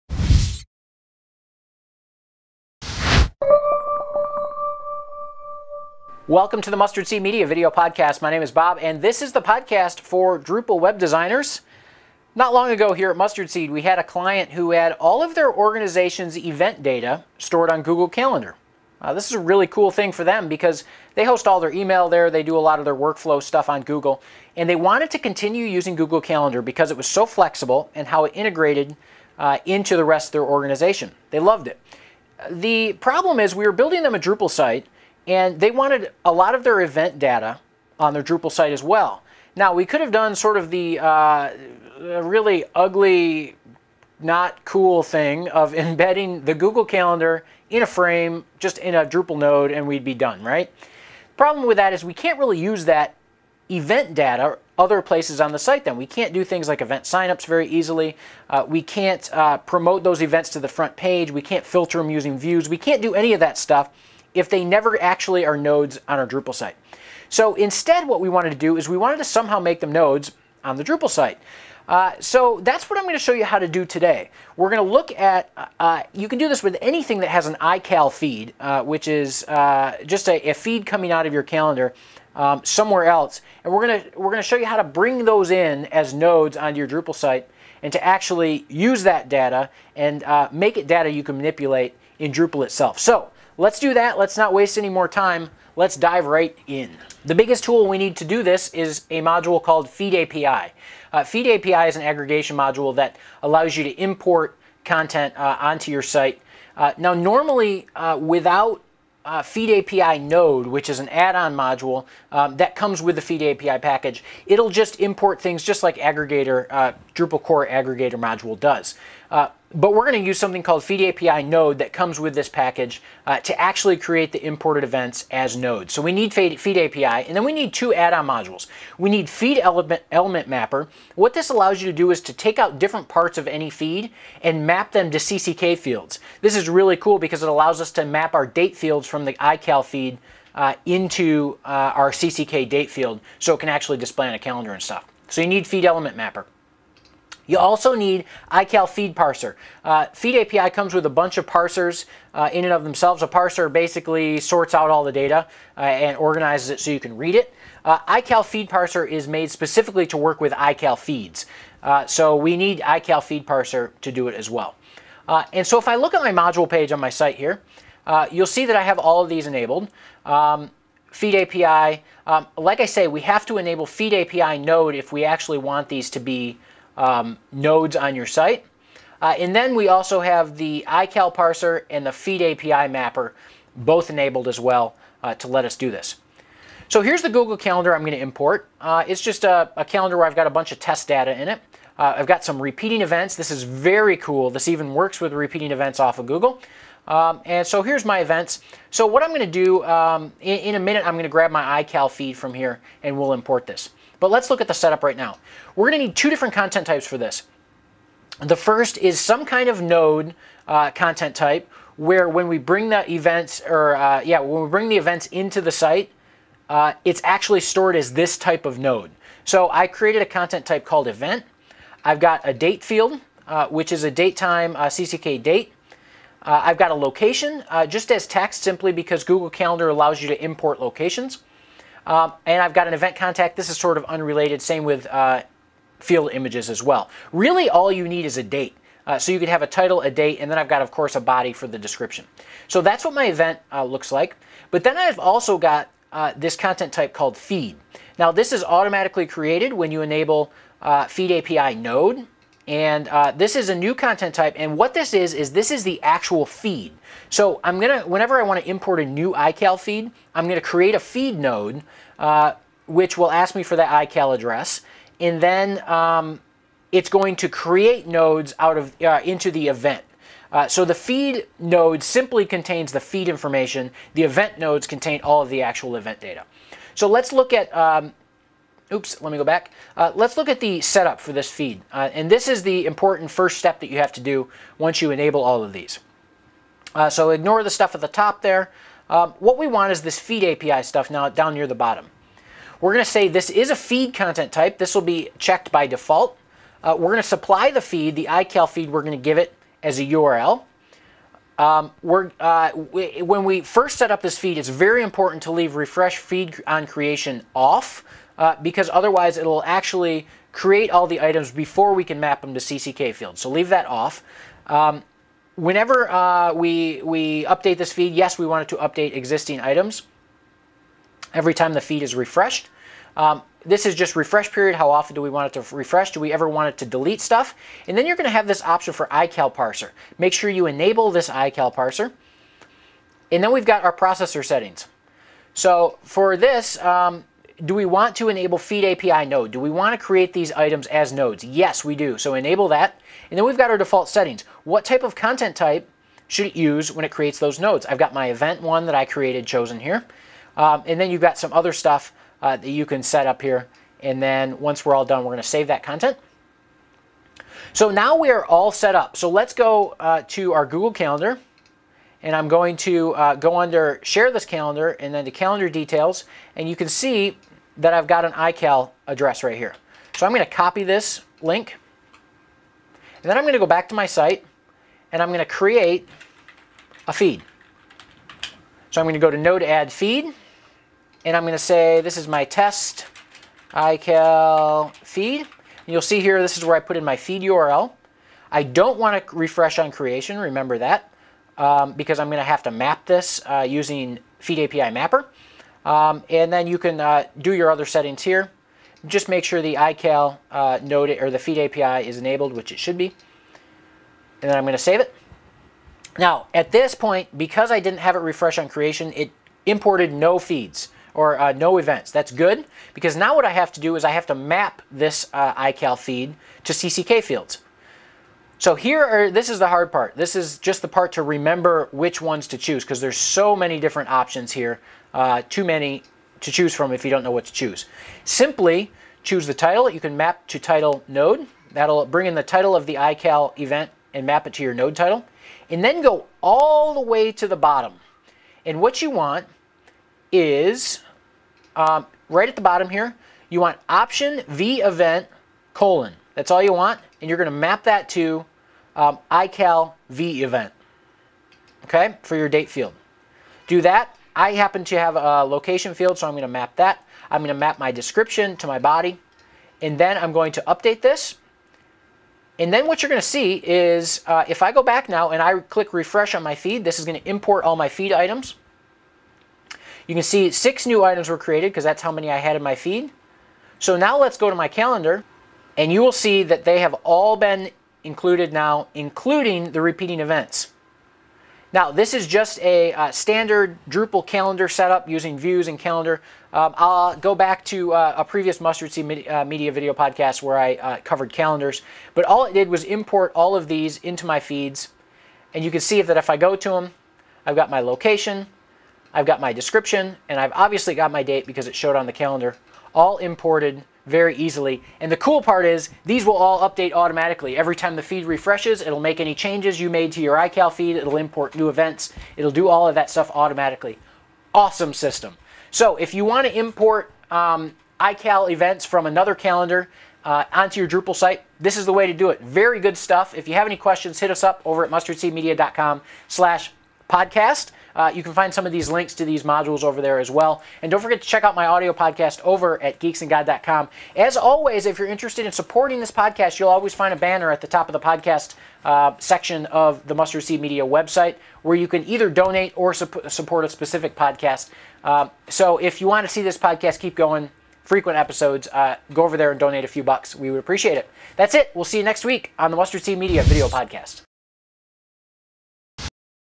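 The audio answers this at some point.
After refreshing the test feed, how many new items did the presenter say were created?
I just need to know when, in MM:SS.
07:50.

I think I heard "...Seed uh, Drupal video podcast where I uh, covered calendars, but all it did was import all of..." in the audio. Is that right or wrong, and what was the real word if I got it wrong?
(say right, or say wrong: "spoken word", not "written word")
wrong: "Media", not "Drupal".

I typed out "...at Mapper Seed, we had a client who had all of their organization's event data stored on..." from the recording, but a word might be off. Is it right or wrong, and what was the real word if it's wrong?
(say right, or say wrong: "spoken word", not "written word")
wrong: "Mustard", not "Mapper".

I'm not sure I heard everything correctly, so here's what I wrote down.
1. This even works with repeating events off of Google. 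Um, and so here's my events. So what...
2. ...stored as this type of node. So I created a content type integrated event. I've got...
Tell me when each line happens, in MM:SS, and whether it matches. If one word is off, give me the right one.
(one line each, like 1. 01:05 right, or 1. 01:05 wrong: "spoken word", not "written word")
1. 03:14 right
2. 03:37 wrong: "called", not "integrated".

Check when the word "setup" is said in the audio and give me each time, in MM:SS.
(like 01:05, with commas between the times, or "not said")
03:24, 04:40, 08:04.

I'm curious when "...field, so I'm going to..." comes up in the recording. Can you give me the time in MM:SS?
07:35.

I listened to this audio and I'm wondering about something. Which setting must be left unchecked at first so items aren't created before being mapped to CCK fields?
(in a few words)
refresh feed on creation.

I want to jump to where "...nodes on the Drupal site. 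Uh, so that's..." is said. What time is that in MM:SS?
01:09.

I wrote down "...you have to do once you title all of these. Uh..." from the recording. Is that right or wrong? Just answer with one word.
wrong.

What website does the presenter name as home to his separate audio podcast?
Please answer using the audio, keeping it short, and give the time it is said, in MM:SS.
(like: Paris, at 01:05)
geeksandgod.com, at 08:53.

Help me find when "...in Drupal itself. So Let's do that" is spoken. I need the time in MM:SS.
01:32.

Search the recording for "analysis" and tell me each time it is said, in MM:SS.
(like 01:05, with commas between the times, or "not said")
not said.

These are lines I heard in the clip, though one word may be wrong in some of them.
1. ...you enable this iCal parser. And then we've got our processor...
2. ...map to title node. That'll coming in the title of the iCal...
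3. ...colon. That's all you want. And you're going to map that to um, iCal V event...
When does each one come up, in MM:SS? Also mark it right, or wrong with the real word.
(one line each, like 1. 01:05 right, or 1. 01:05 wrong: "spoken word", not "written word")
1. 05:30 right
2. 07:10 wrong: "bring", not "coming"
3. 07:25 right.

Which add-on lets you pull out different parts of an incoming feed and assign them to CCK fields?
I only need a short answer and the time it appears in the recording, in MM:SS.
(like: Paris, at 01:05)
feed element mapper, at 02:25.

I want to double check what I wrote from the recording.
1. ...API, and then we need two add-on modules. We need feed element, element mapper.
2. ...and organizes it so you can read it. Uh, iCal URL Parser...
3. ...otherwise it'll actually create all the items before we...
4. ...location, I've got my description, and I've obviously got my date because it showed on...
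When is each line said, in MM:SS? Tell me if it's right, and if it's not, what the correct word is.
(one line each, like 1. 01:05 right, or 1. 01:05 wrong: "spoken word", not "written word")
1. 02:06 right
2. 02:35 wrong: "Feed", not "URL"
3. 05:08 right
4. 08:17 right.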